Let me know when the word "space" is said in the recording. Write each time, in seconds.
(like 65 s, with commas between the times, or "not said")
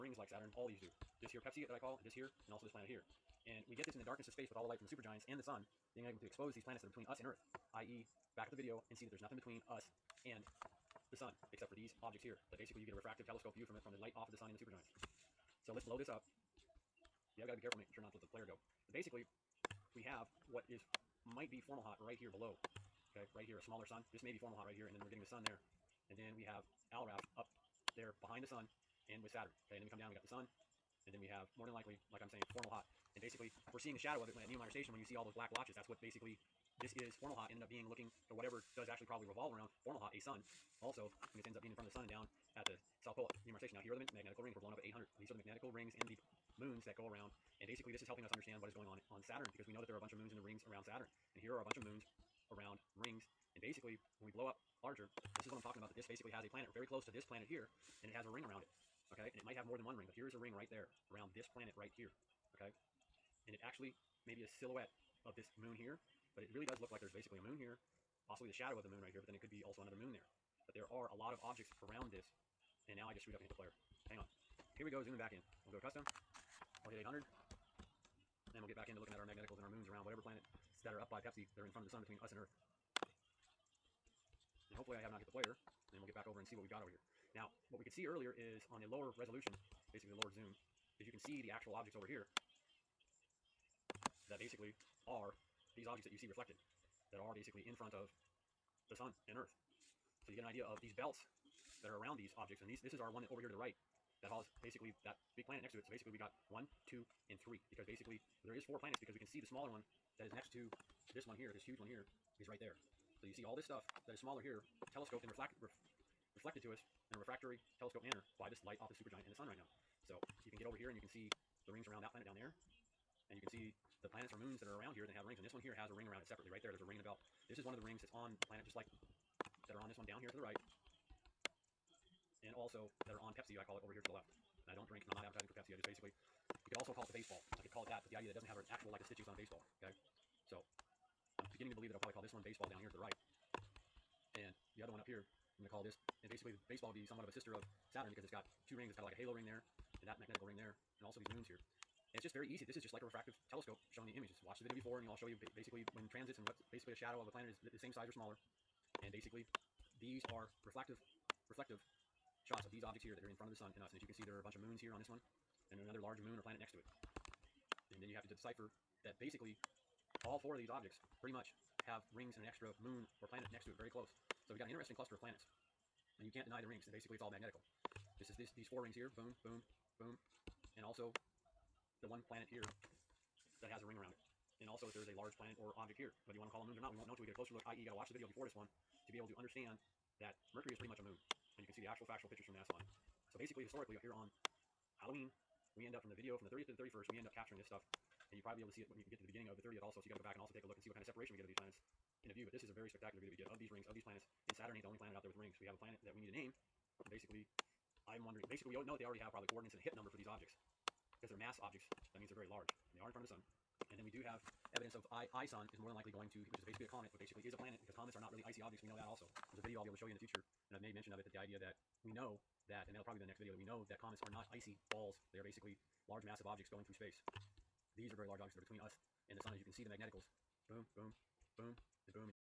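4 s, 226 s.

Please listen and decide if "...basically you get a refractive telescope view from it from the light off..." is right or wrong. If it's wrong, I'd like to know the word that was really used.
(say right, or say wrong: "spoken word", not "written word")
right.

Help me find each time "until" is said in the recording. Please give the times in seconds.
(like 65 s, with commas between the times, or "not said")
187 s.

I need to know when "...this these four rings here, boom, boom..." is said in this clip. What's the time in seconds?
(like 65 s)
178 s.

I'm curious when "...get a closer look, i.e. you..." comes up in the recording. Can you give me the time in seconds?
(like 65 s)
187 s.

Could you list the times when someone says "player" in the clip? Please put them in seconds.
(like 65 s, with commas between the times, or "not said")
18 s, 73 s, 85 s.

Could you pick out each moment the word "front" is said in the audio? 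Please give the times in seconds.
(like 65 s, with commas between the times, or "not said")
41 s, 81 s, 97 s, 163 s, 213 s.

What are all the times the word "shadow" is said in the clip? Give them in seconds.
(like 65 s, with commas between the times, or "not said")
33 s, 68 s, 156 s.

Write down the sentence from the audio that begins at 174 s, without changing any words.
So we have got an interesting cluster of planets.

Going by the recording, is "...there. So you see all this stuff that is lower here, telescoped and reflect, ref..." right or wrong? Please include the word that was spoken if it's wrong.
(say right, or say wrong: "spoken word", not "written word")
wrong: "smaller", not "lower".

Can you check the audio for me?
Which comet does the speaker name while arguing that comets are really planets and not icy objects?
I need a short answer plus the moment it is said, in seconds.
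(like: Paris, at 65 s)
ISON, at 215 s.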